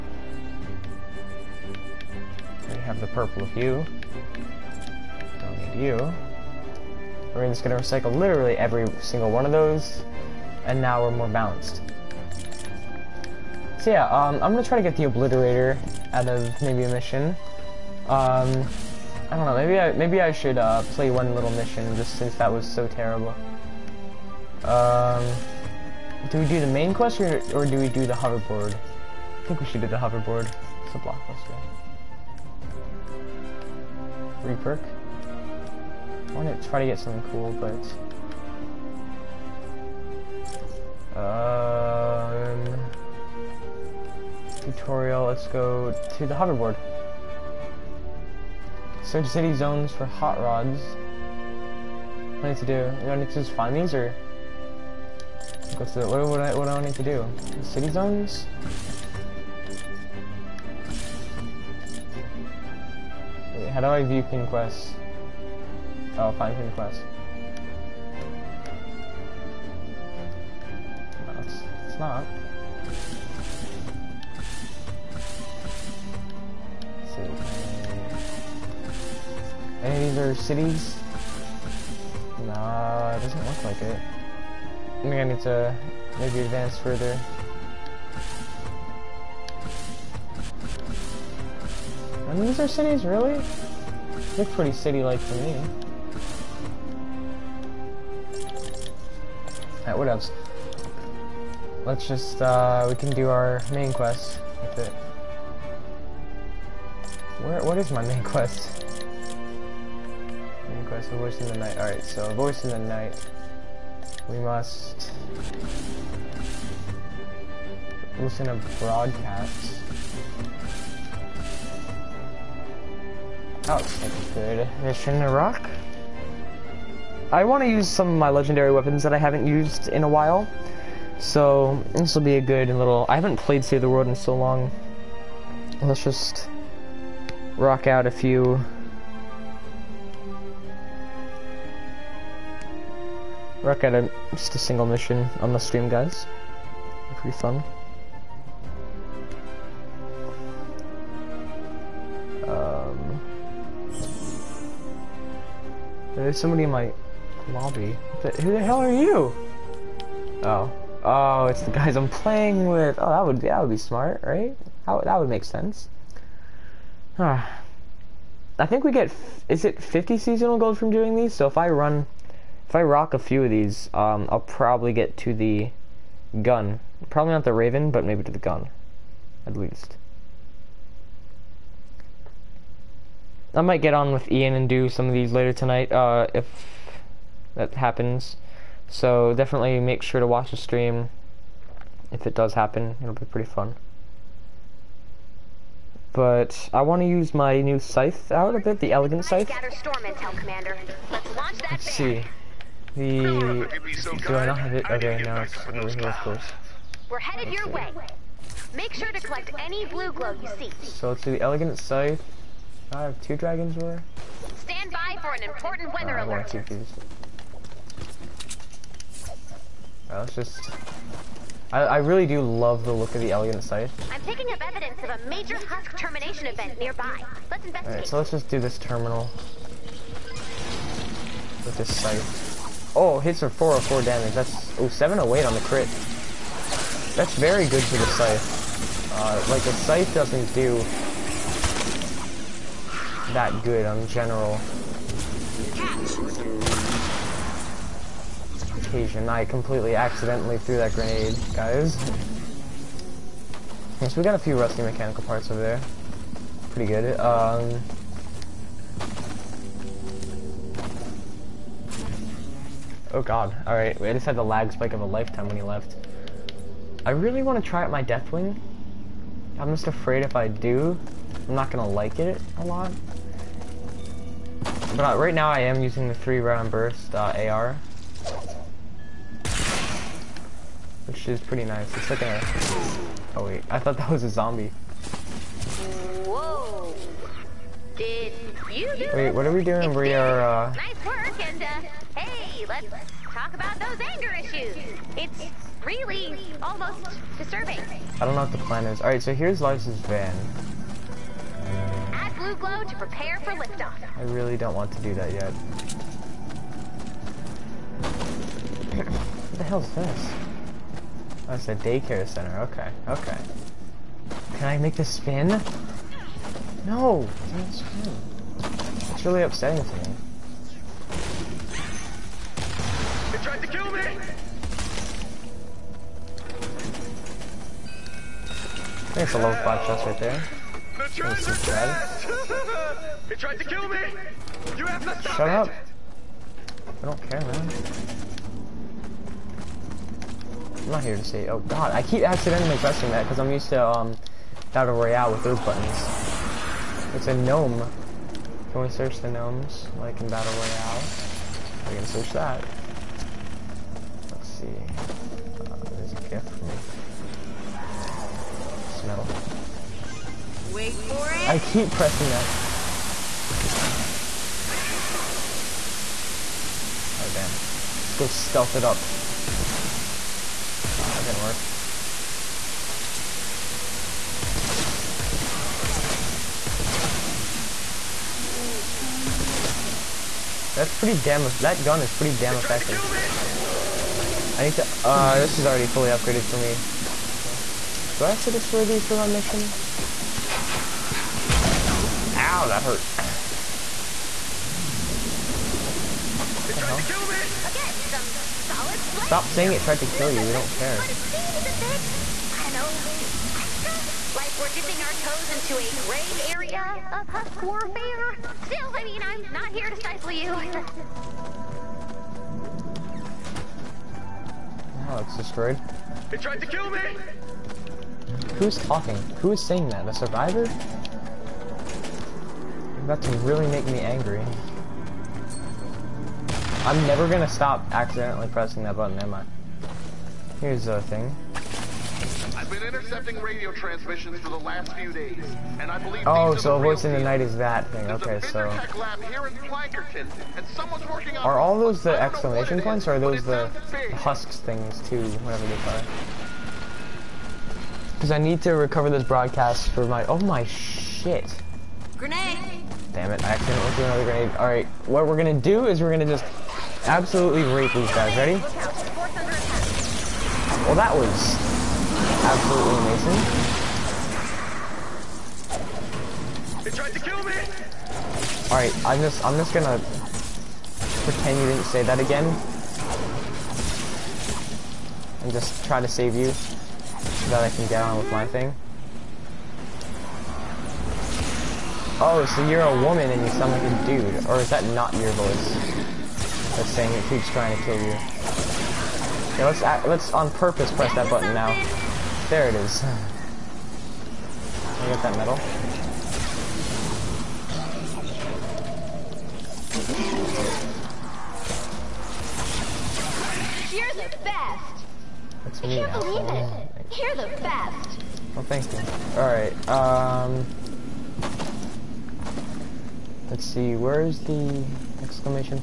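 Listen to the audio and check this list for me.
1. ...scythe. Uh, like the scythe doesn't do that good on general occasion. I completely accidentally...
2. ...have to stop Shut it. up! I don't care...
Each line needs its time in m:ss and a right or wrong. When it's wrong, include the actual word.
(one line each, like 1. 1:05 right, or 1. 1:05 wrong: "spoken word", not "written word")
1. 3:58 right
2. 5:34 right.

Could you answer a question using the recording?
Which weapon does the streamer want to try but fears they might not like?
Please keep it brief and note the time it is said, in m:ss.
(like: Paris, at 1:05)
Deathwing, at 4:28.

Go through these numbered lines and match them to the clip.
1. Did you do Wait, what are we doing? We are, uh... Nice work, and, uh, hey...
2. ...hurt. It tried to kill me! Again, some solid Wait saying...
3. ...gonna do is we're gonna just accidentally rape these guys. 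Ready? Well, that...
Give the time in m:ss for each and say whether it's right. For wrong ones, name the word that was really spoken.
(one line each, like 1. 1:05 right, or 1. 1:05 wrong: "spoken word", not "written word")
1. 4:48 right
2. 6:32 wrong: "Stop", not "Wait"
3. 7:35 wrong: "absolutely", not "accidentally".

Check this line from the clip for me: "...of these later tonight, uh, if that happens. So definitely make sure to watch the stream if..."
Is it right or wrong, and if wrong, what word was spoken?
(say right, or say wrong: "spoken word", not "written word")
right.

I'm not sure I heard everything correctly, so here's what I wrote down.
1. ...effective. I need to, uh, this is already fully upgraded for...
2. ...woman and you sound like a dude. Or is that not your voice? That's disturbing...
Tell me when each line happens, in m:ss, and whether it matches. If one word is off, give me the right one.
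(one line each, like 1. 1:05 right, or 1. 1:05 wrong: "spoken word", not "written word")
1. 6:22 right
2. 8:03 wrong: "saying", not "disturbing".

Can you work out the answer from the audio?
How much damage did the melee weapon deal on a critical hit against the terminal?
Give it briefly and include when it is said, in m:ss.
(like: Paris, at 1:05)
708, at 3:54.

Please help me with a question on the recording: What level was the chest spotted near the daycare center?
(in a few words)
Level 5.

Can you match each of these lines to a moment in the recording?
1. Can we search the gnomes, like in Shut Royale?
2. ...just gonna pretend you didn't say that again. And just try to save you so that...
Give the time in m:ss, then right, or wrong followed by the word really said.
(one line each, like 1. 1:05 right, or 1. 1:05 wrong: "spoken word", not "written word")
1. 5:48 wrong: "Battle", not "Shut"
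2. 7:49 right.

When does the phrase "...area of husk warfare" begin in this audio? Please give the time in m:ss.
6:46.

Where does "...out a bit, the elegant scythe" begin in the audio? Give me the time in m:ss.
3:18.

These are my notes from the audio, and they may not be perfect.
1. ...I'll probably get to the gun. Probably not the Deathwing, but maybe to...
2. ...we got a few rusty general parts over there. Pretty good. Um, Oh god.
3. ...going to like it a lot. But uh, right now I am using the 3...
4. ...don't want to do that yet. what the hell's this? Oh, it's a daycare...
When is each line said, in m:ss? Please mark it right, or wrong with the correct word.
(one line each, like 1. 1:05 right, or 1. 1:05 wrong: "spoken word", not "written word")
1. 2:54 wrong: "Raven", not "Deathwing"
2. 4:14 wrong: "mechanical", not "general"
3. 4:31 right
4. 5:04 right.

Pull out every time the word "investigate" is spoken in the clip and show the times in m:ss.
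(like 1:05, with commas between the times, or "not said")
3:47.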